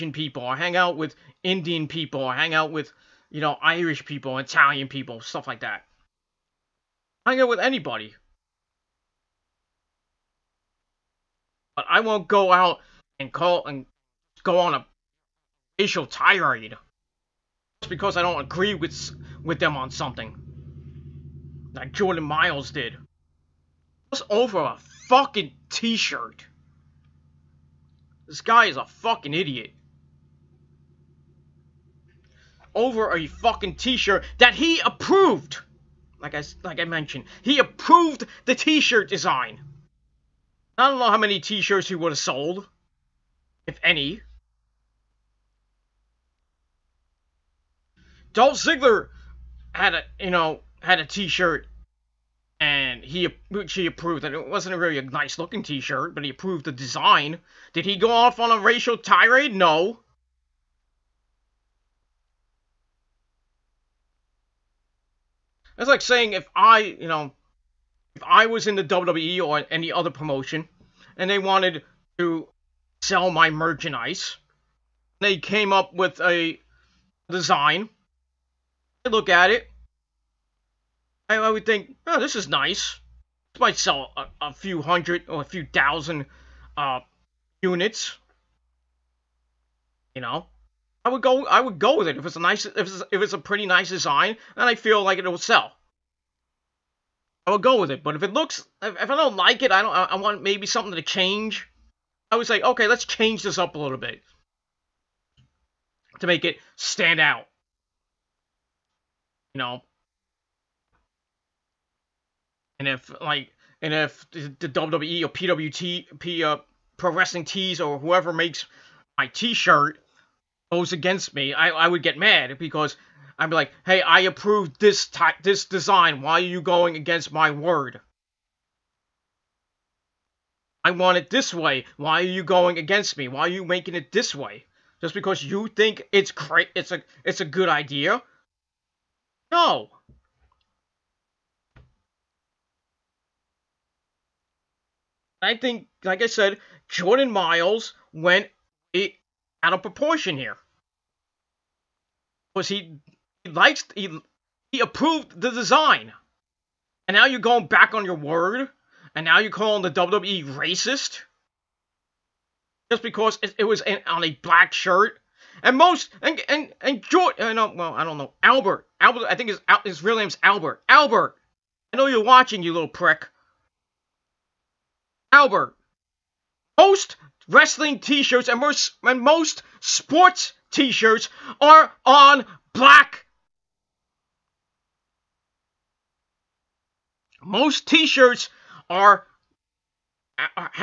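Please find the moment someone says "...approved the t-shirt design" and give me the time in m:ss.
0:37.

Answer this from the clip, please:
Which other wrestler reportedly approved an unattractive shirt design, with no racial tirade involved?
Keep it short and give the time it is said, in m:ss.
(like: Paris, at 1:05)
Dolph Ziggler, at 0:48.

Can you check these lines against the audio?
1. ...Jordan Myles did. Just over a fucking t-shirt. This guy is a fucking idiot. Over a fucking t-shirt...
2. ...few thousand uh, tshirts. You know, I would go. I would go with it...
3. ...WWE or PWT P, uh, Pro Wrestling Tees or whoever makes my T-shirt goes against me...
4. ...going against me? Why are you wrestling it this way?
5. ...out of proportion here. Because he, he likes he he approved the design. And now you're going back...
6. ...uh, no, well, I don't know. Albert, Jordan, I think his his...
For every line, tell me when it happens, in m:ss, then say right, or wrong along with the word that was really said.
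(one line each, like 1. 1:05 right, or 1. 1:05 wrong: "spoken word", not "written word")
1. 0:21 right
2. 1:25 wrong: "units", not "tshirts"
3. 1:54 right
4. 2:12 wrong: "making", not "wrestling"
5. 2:29 right
6. 2:47 wrong: "Albert", not "Jordan".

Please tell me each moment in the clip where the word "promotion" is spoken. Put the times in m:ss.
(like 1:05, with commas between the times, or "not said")
1:10.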